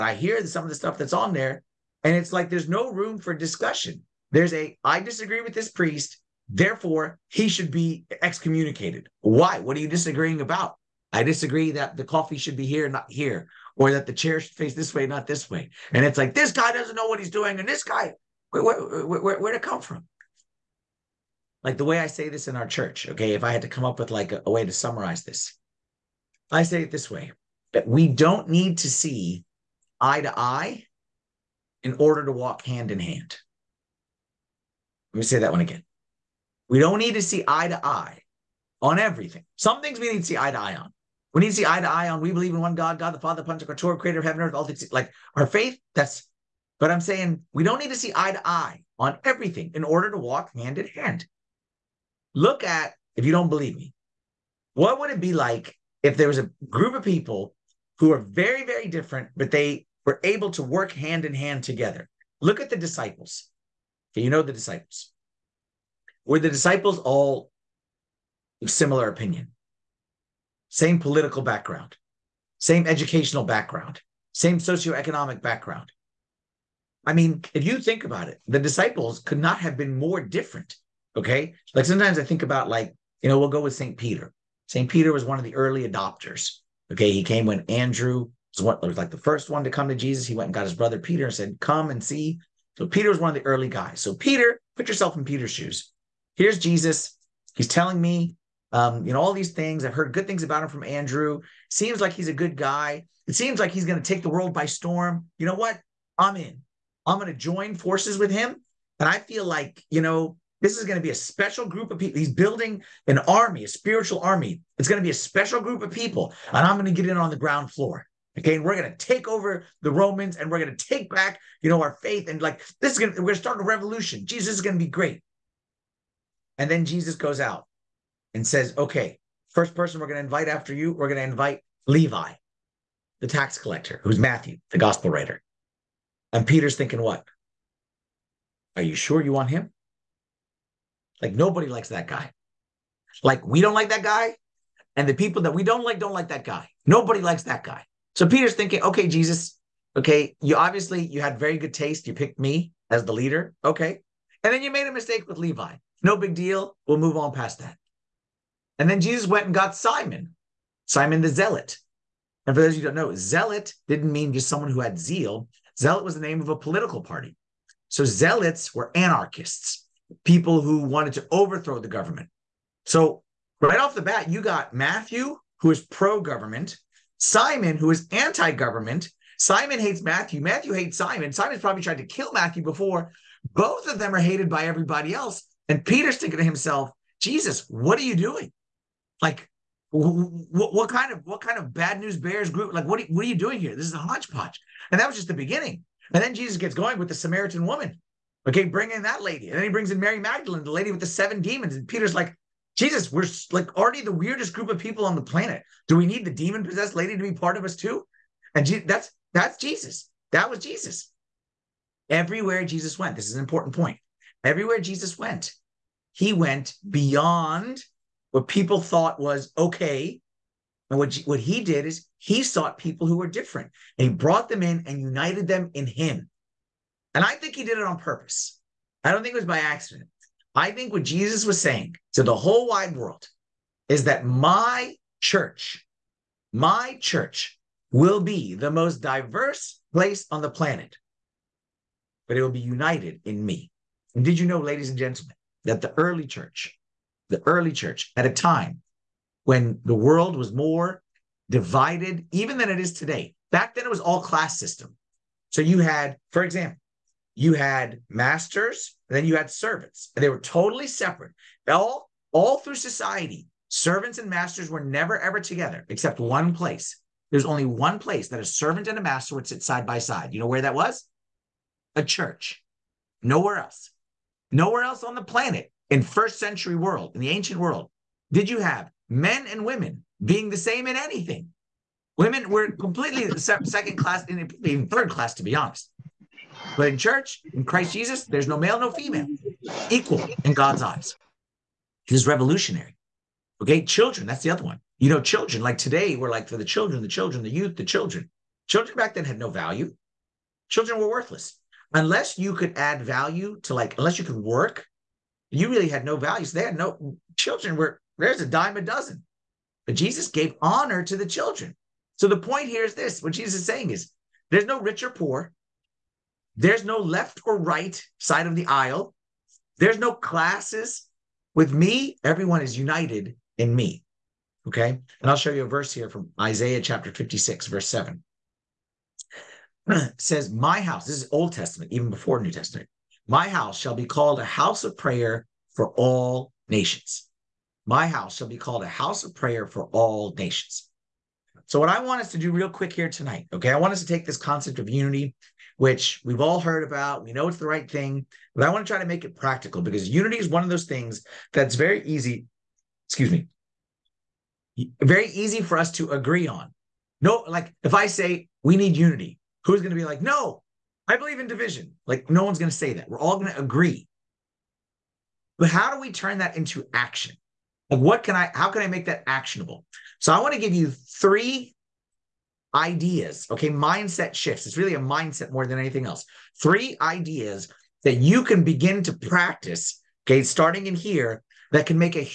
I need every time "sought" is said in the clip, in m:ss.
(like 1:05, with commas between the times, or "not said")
3:42.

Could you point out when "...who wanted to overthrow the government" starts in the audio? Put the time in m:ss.
2:50.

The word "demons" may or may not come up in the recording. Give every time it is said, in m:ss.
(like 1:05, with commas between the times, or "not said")
3:21, 3:26.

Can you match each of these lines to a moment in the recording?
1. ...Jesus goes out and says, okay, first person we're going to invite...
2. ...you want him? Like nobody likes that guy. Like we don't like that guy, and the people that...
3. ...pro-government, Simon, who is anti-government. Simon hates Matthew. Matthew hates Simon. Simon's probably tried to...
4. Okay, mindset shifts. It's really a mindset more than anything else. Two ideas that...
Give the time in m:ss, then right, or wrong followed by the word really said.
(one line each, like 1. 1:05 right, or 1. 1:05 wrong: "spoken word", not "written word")
1. 2:06 right
2. 2:19 right
3. 2:55 right
4. 6:13 wrong: "Three", not "Two".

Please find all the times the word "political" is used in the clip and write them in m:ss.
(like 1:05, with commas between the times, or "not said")
1:10, 2:46.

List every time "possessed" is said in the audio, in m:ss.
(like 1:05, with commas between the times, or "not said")
3:26.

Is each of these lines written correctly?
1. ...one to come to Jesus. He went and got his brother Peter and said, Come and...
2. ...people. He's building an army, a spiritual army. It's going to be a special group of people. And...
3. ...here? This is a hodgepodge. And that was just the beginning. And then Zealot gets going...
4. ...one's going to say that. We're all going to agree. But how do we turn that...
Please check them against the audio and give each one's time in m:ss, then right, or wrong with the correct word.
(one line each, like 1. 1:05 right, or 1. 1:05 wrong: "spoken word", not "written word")
1. 1:29 right
2. 1:51 right
3. 3:13 wrong: "Jesus", not "Zealot"
4. 6:02 right.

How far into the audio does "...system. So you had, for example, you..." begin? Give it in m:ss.
4:14.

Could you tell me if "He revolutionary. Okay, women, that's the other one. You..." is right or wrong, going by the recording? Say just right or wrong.
wrong.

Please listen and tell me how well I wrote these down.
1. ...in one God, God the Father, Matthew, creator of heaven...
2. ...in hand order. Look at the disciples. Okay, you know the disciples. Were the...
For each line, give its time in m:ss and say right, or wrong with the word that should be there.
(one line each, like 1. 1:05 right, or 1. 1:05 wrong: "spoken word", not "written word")
1. 0:42 wrong: "Pantocrator", not "Matthew"
2. 1:01 wrong: "together", not "order".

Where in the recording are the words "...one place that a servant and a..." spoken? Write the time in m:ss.
4:27.